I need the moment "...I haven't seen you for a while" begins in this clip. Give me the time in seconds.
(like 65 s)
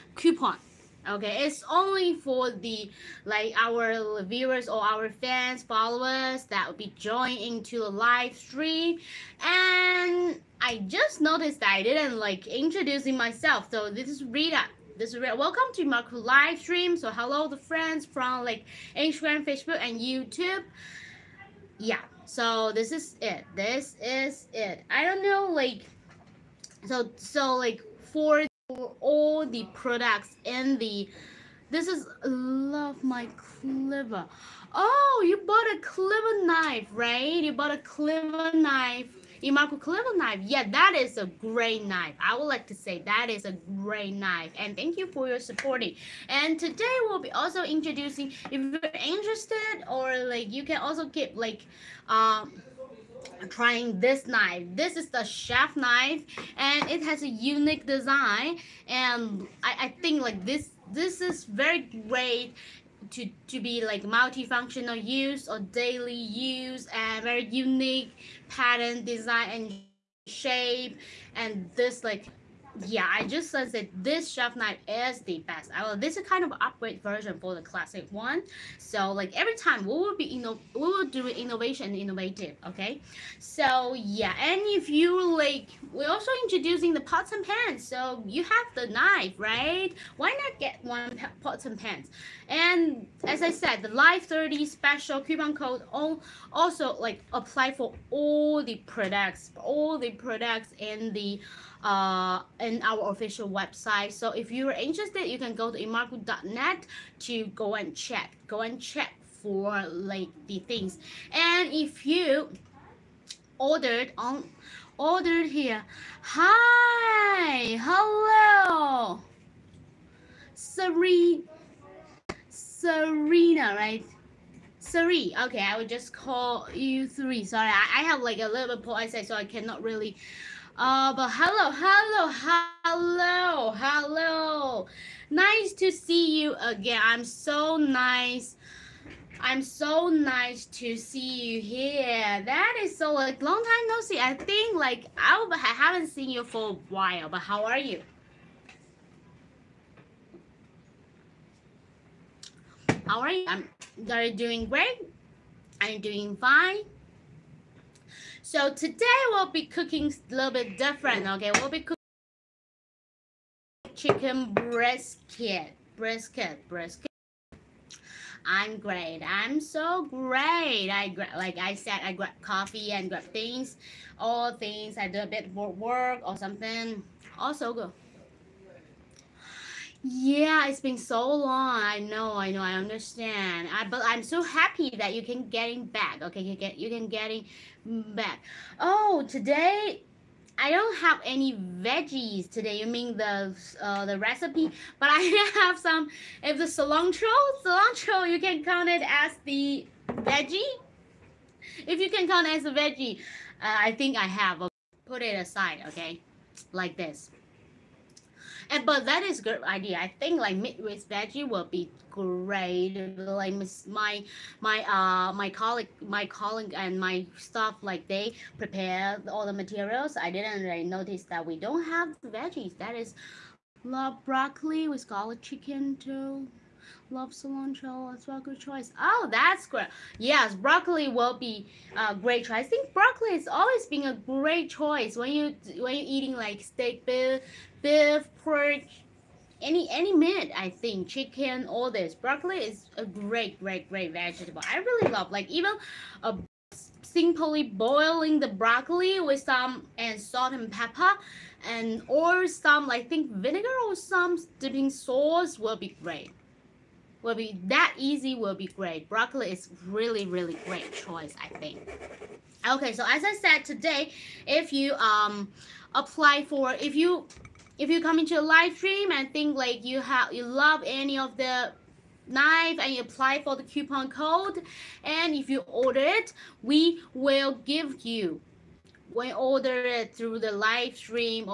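145 s.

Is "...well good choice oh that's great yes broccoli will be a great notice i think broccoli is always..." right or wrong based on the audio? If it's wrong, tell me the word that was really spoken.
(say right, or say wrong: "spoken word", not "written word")
wrong: "choice", not "notice".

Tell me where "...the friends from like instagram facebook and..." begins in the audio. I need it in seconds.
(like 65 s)
17 s.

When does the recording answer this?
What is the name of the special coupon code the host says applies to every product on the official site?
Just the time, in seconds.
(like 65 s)
93 s.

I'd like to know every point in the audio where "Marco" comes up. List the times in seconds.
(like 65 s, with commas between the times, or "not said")
15 s.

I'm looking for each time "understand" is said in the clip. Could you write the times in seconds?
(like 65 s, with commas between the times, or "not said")
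182 s.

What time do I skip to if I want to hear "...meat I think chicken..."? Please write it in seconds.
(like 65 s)
240 s.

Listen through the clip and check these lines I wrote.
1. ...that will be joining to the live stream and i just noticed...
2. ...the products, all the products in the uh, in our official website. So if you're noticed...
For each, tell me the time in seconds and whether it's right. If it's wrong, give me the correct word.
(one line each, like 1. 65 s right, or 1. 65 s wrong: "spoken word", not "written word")
1. 6 s right
2. 98 s wrong: "interested", not "noticed".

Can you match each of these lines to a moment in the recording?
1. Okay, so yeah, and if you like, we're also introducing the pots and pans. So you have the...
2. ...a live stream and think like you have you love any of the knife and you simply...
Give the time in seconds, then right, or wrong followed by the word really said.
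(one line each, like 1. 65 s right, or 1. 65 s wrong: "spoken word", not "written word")
1. 82 s right
2. 268 s wrong: "apply", not "simply".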